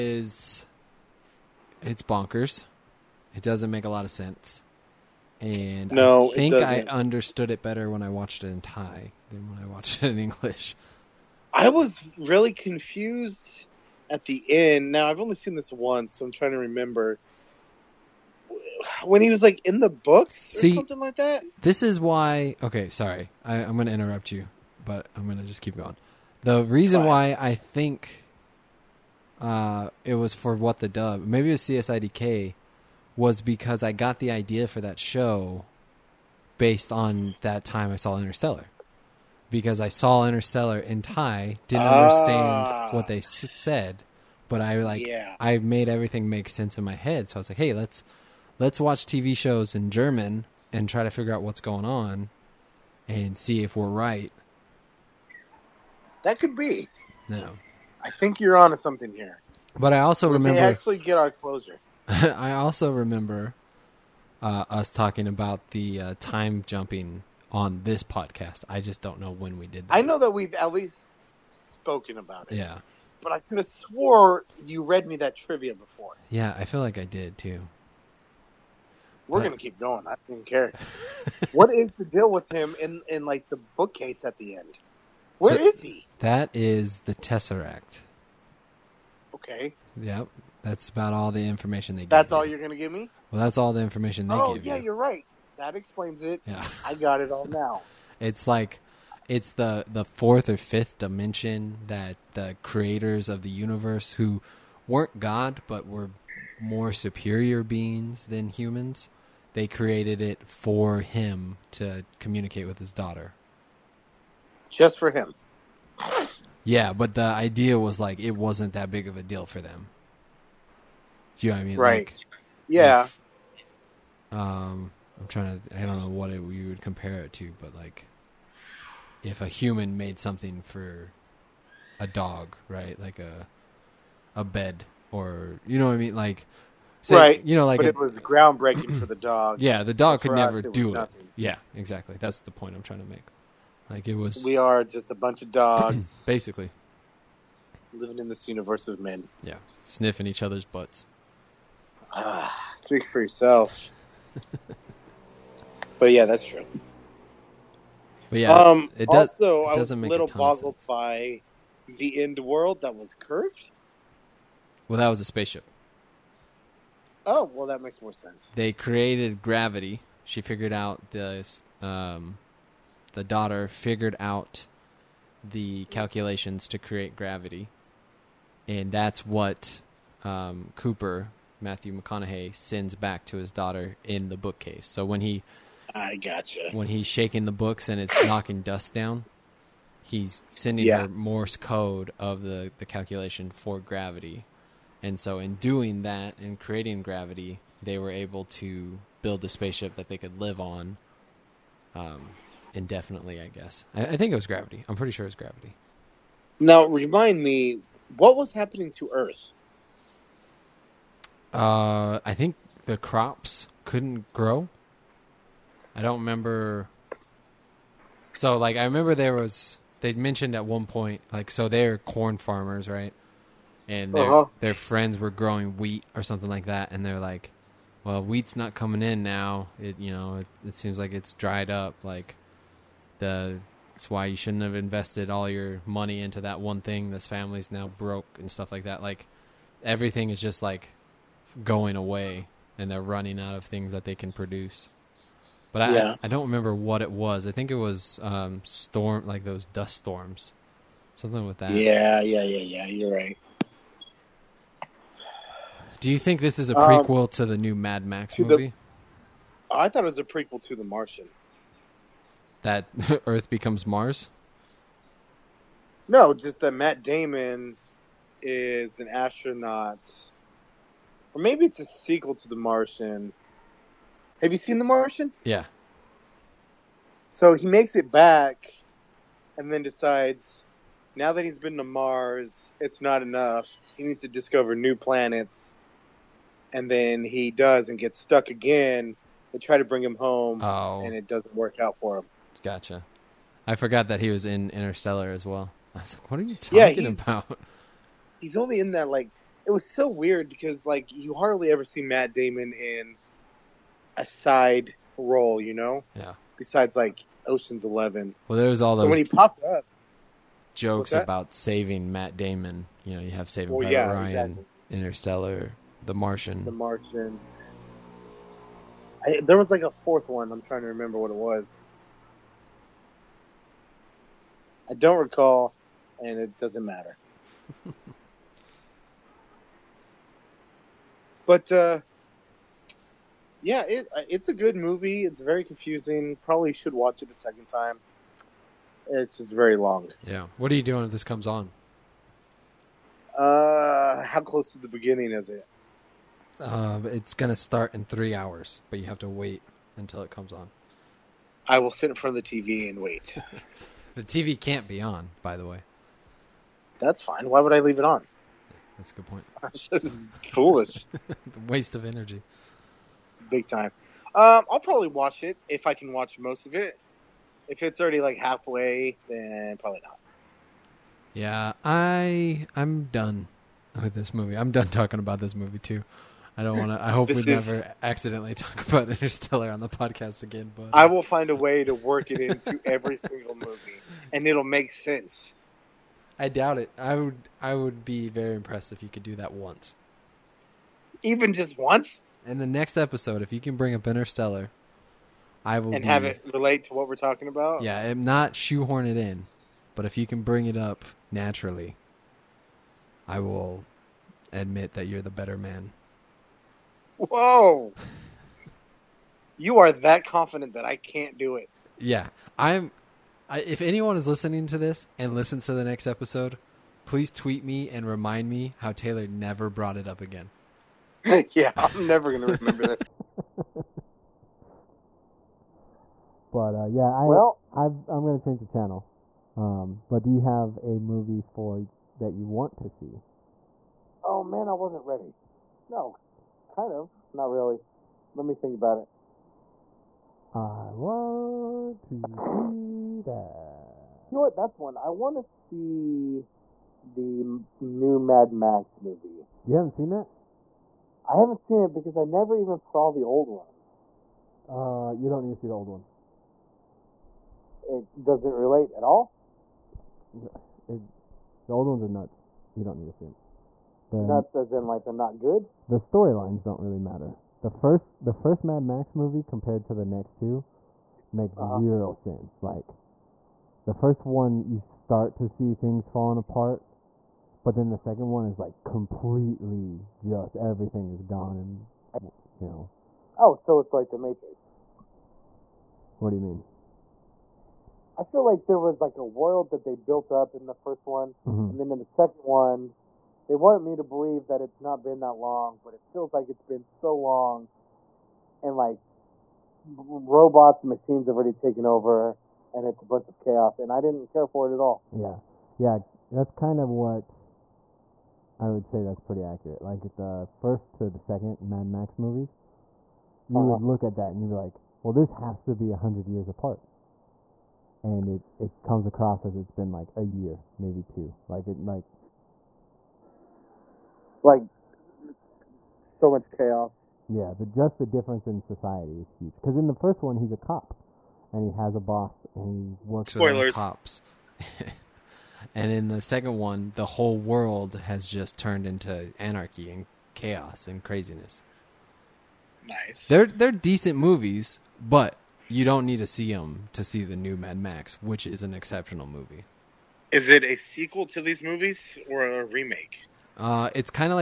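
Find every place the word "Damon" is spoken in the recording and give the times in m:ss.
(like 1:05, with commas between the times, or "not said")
4:27, 5:02, 5:12.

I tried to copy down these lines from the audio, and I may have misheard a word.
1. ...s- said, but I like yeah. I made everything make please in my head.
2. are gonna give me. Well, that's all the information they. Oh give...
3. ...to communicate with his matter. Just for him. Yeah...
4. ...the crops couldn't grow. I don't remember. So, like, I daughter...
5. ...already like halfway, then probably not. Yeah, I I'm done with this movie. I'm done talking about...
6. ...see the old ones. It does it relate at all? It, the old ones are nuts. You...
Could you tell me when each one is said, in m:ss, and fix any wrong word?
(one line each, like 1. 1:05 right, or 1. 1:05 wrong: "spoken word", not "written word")
1. 0:43 wrong: "sense", not "please"
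2. 1:32 right
3. 1:51 wrong: "daughter", not "matter"
4. 3:32 wrong: "remember", not "daughter"
5. 6:08 right
6. 7:35 right.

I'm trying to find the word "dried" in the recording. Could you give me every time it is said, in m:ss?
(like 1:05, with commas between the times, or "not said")
3:51.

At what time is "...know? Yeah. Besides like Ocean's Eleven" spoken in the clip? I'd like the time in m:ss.
5:05.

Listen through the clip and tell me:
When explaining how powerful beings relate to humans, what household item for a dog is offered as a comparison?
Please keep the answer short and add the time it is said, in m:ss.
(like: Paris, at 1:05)
a bed, at 2:13.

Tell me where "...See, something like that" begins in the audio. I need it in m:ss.
0:20.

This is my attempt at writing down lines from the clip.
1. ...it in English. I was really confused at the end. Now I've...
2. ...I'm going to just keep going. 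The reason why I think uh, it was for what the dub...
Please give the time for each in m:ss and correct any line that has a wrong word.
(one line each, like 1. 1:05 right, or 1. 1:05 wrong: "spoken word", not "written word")
1. 0:10 right
2. 0:25 right.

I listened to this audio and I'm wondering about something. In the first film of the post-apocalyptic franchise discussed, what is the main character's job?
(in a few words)
cop.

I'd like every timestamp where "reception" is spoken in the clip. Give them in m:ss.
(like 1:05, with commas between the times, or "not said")
not said.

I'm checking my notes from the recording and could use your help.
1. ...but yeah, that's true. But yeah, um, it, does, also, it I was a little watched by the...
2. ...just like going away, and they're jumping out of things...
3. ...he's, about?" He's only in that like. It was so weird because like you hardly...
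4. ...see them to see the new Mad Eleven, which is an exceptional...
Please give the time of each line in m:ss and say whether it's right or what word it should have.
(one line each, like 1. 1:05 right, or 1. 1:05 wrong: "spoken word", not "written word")
1. 2:35 wrong: "boggled", not "watched"
2. 4:00 wrong: "running", not "jumping"
3. 4:56 right
4. 9:06 wrong: "Max", not "Eleven".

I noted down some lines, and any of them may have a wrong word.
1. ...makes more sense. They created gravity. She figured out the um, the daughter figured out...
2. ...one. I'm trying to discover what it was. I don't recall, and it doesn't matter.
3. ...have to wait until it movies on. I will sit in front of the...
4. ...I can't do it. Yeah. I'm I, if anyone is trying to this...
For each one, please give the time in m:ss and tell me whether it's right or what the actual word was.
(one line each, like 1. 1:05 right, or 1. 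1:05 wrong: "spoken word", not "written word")
1. 2:47 right
2. 5:20 wrong: "remember", not "discover"
3. 5:49 wrong: "comes", not "movies"
4. 6:50 wrong: "listening", not "trying".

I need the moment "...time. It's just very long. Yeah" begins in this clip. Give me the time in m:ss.
5:37.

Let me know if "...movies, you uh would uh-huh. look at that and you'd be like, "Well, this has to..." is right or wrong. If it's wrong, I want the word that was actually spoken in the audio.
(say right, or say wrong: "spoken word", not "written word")
right.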